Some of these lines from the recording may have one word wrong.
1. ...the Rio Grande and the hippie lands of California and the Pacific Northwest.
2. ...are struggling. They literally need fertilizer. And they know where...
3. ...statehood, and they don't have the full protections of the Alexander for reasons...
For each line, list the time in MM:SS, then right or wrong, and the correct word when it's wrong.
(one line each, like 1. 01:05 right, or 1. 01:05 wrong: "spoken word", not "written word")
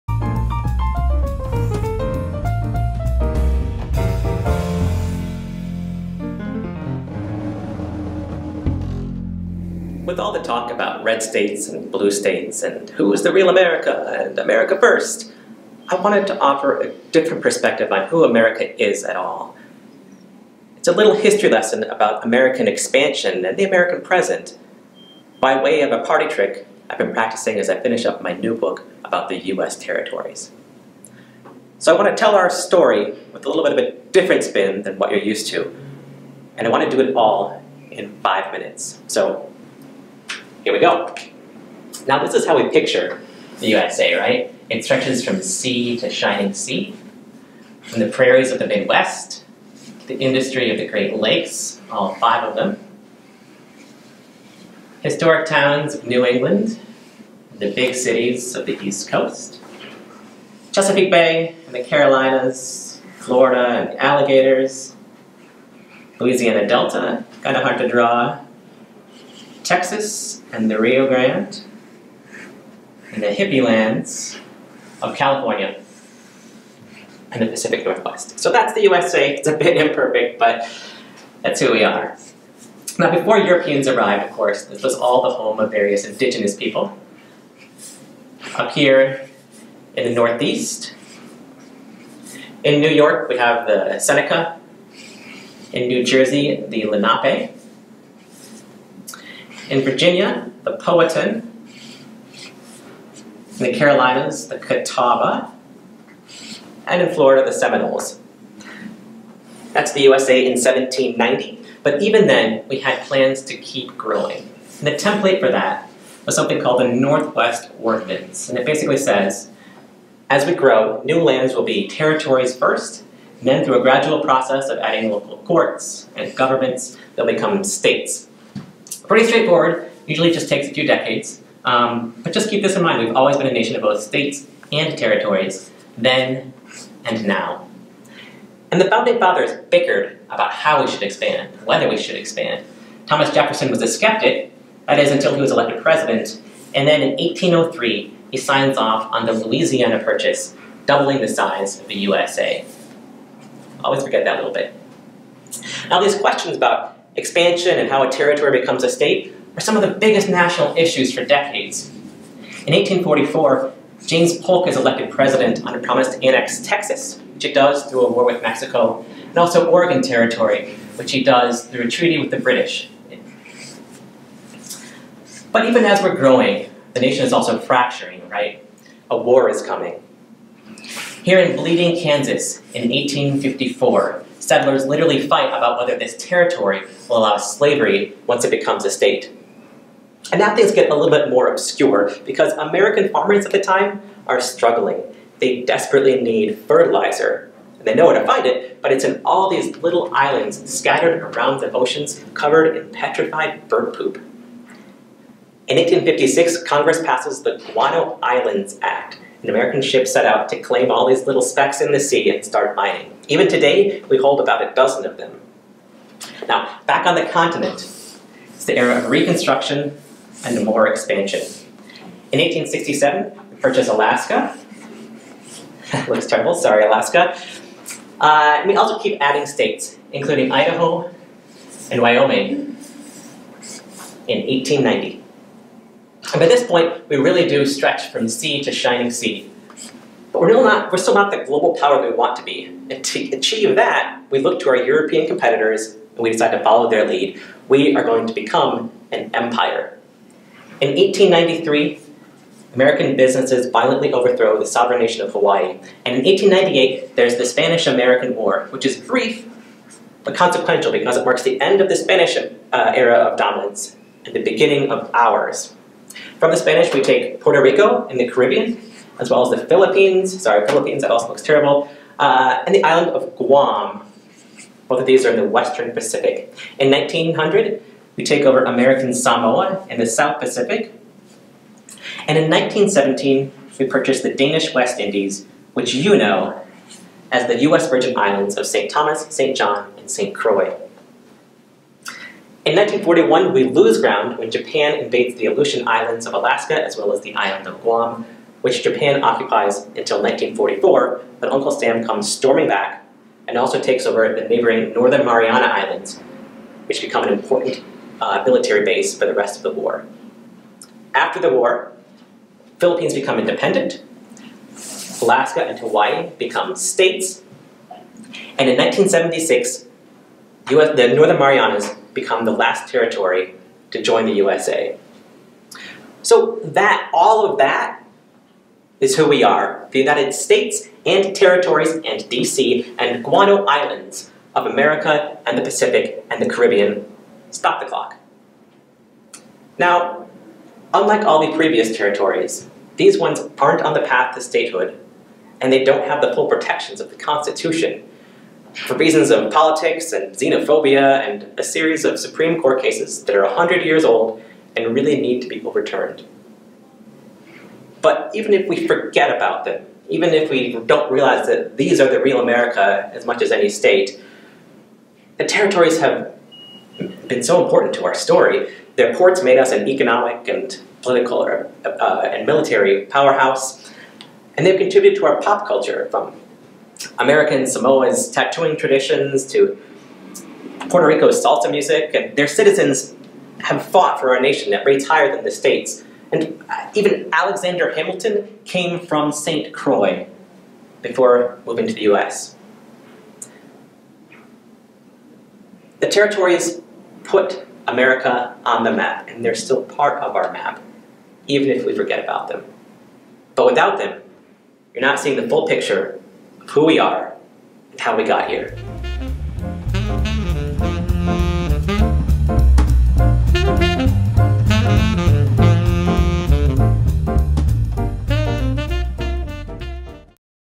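1. 01:10 right
2. 03:14 wrong: "desperately", not "literally"
3. 05:44 wrong: "Constitution", not "Alexander".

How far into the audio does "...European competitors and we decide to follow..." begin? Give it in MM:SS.
04:04.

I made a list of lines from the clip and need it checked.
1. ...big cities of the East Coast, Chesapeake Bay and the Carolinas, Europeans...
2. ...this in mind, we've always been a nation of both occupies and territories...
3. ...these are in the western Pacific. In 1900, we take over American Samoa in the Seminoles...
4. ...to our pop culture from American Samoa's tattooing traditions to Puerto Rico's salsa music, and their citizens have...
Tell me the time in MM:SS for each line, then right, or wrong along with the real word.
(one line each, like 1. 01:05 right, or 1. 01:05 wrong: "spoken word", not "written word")
1. 00:57 wrong: "Florida", not "Europeans"
2. 02:12 wrong: "states", not "occupies"
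3. 04:35 wrong: "South", not "Seminoles"
4. 06:15 right.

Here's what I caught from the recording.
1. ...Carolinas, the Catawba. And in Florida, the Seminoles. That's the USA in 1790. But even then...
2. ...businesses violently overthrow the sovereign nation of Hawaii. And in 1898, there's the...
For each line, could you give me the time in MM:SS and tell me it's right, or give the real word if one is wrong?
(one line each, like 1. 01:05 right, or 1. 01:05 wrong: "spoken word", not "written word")
1. 01:43 right
2. 04:13 right.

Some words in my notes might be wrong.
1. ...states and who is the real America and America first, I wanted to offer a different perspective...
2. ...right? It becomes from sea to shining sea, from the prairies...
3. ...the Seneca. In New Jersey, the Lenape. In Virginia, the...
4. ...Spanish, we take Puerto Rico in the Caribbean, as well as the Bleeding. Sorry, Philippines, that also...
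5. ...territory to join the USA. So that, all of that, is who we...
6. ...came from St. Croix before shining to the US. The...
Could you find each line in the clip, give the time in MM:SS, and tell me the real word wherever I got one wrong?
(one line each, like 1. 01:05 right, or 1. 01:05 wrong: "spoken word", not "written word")
1. 00:12 right
2. 00:44 wrong: "stretches", not "becomes"
3. 01:33 right
4. 04:26 wrong: "Philippines", not "Bleeding"
5. 05:22 right
6. 06:28 wrong: "moving", not "shining".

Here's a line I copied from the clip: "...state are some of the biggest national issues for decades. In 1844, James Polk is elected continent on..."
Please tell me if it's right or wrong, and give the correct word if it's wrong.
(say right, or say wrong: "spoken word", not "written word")
wrong: "president", not "continent".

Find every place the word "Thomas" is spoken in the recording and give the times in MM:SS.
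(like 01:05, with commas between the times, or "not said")
02:23, 04:48.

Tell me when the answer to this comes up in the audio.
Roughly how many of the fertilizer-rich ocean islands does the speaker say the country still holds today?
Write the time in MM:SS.
03:34.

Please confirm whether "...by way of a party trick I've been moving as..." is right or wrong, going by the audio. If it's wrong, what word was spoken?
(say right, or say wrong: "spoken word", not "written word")
wrong: "practicing", not "moving".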